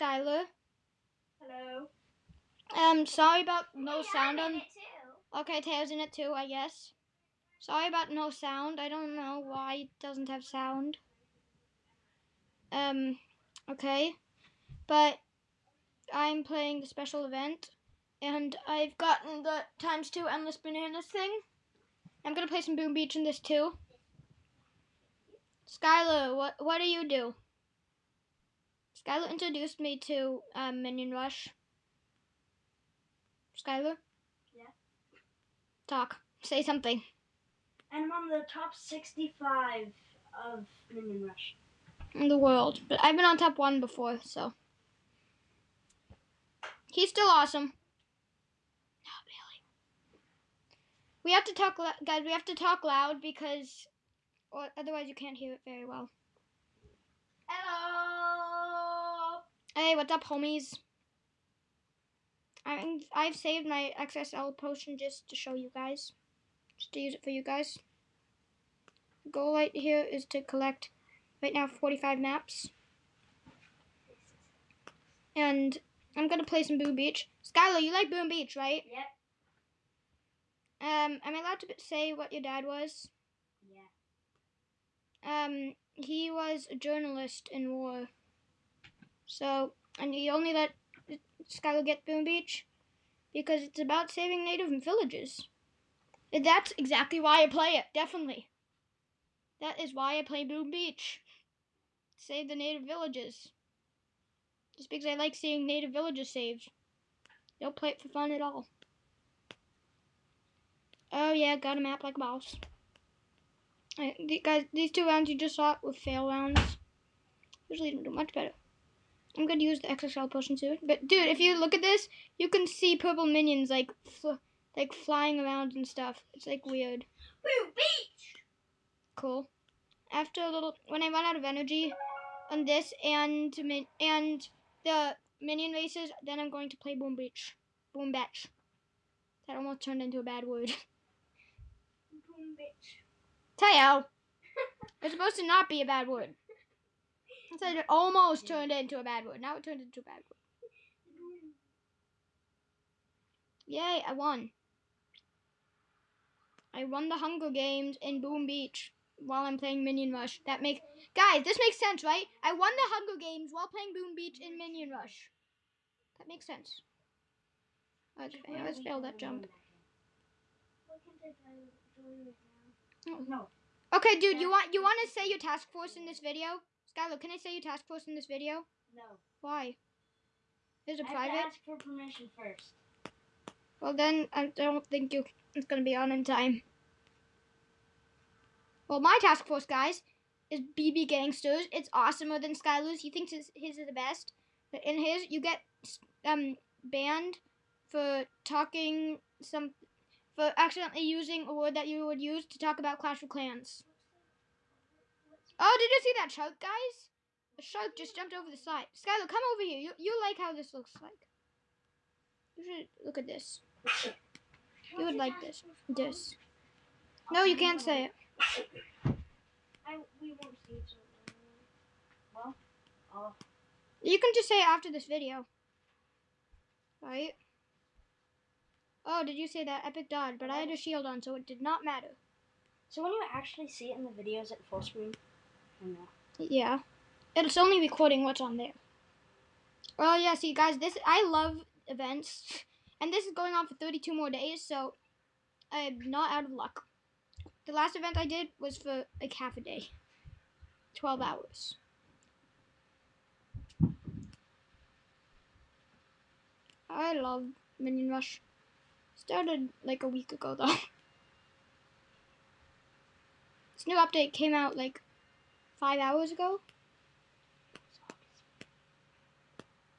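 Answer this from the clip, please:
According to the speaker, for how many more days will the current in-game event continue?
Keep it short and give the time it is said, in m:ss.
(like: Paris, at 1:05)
32, at 4:03.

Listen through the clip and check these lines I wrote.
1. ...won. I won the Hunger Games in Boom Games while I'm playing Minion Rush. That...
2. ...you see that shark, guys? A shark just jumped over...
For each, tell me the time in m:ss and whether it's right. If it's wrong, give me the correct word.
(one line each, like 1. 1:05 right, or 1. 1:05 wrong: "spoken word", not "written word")
1. 2:34 wrong: "Beach", not "Games"
2. 3:25 right.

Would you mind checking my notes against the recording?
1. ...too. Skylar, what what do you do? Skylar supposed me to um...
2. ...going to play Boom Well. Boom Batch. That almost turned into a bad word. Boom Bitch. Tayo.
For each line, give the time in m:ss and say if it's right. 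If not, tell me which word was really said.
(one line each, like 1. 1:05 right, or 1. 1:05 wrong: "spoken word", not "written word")
1. 0:23 wrong: "introduced", not "supposed"
2. 2:16 wrong: "Beach", not "Well".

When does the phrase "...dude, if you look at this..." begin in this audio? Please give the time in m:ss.
2:01.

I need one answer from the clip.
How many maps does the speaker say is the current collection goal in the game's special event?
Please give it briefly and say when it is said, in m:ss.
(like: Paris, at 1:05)
45, at 1:11.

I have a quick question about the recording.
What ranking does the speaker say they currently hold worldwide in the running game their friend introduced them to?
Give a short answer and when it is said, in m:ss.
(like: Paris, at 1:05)
Top 65, at 0:38.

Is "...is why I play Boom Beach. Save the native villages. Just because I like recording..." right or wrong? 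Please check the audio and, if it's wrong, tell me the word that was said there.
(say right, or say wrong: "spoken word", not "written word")
wrong: "seeing", not "recording".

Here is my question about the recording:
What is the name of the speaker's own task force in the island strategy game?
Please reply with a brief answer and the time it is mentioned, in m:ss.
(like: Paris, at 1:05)
BB Gangsters, at 3:10.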